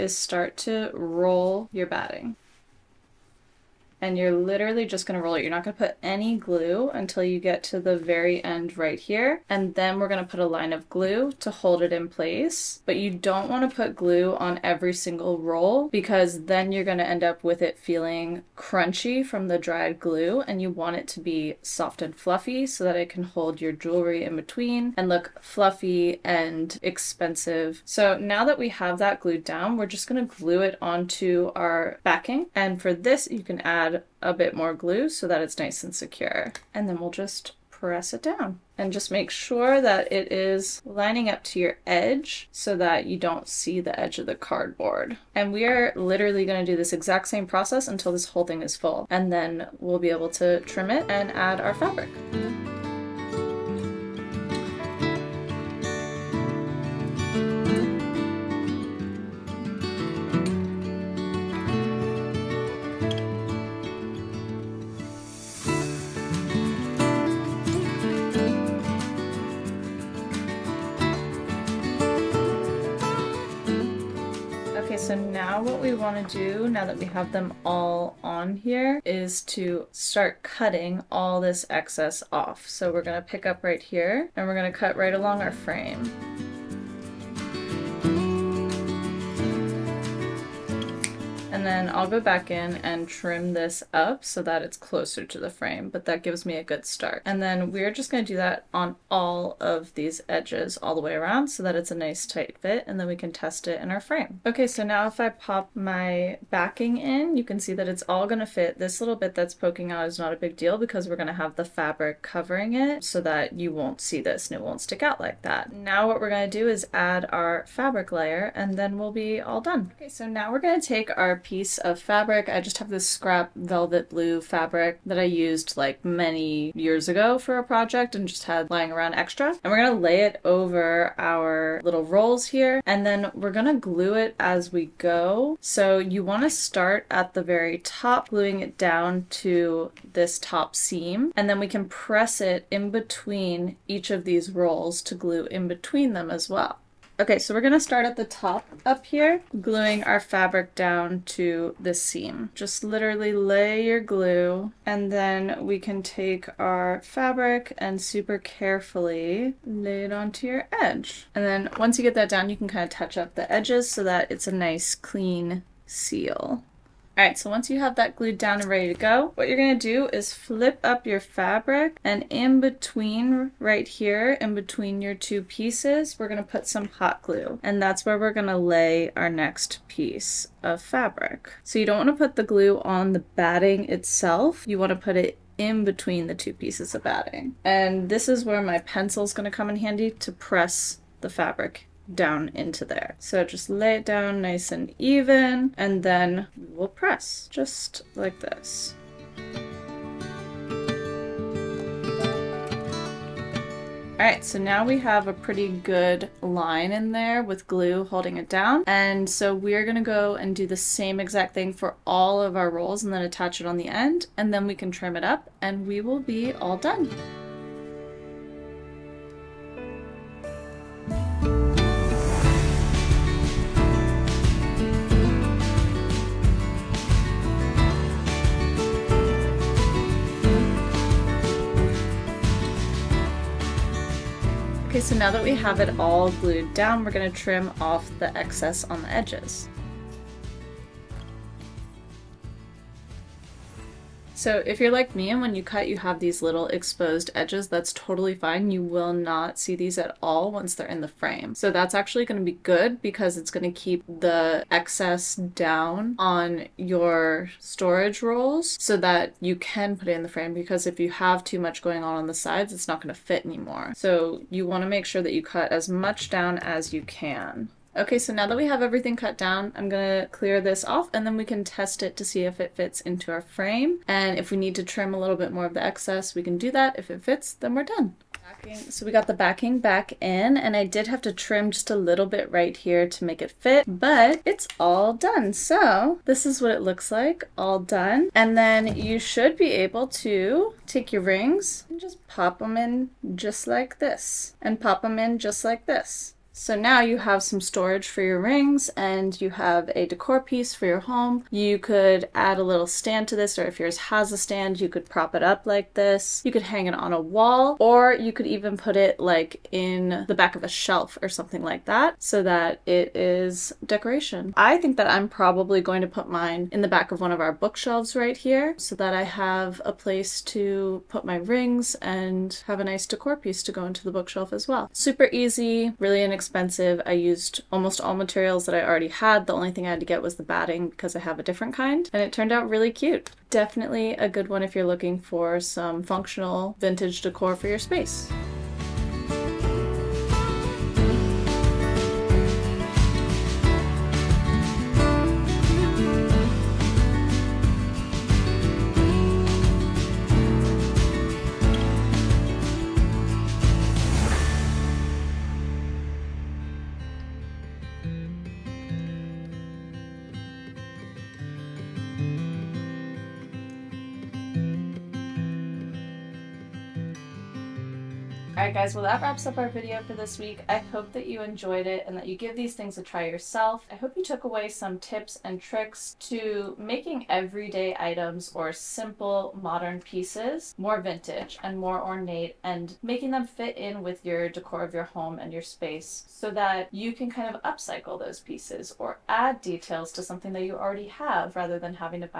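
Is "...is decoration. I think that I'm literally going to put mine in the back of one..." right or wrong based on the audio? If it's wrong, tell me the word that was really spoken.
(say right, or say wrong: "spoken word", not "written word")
wrong: "probably", not "literally".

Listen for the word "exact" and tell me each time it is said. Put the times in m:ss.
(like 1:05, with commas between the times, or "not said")
0:46, 3:31.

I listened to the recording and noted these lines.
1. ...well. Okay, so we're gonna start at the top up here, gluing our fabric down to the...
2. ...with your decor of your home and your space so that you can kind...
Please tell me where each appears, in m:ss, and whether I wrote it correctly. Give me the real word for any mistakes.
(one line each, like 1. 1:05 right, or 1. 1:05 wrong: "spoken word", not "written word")
1. 2:26 right
2. 6:24 right.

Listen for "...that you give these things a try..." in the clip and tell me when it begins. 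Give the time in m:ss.
6:12.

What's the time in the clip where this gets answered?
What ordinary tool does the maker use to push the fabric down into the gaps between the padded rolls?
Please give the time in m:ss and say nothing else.
3:08.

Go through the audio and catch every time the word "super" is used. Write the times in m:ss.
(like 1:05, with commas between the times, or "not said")
2:37, 5:24.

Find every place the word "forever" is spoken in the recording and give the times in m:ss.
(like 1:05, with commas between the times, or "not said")
not said.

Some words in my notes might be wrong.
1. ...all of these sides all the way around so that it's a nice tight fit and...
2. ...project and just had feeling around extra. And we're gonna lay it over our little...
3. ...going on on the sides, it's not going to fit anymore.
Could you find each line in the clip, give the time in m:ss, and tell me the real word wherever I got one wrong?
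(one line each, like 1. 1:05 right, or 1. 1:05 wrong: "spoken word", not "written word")
1. 1:39 wrong: "edges", not "sides"
2. 2:07 wrong: "lying", not "feeling"
3. 4:21 right.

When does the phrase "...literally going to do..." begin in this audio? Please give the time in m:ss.
0:45.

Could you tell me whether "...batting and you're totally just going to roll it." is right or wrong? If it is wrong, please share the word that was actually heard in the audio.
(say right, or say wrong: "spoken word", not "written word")
wrong: "literally", not "totally".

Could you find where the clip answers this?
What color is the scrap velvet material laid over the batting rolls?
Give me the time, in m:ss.
2:04.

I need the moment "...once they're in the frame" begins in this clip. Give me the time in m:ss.
4:10.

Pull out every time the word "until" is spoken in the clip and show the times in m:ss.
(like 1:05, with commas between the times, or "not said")
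0:06, 0:47.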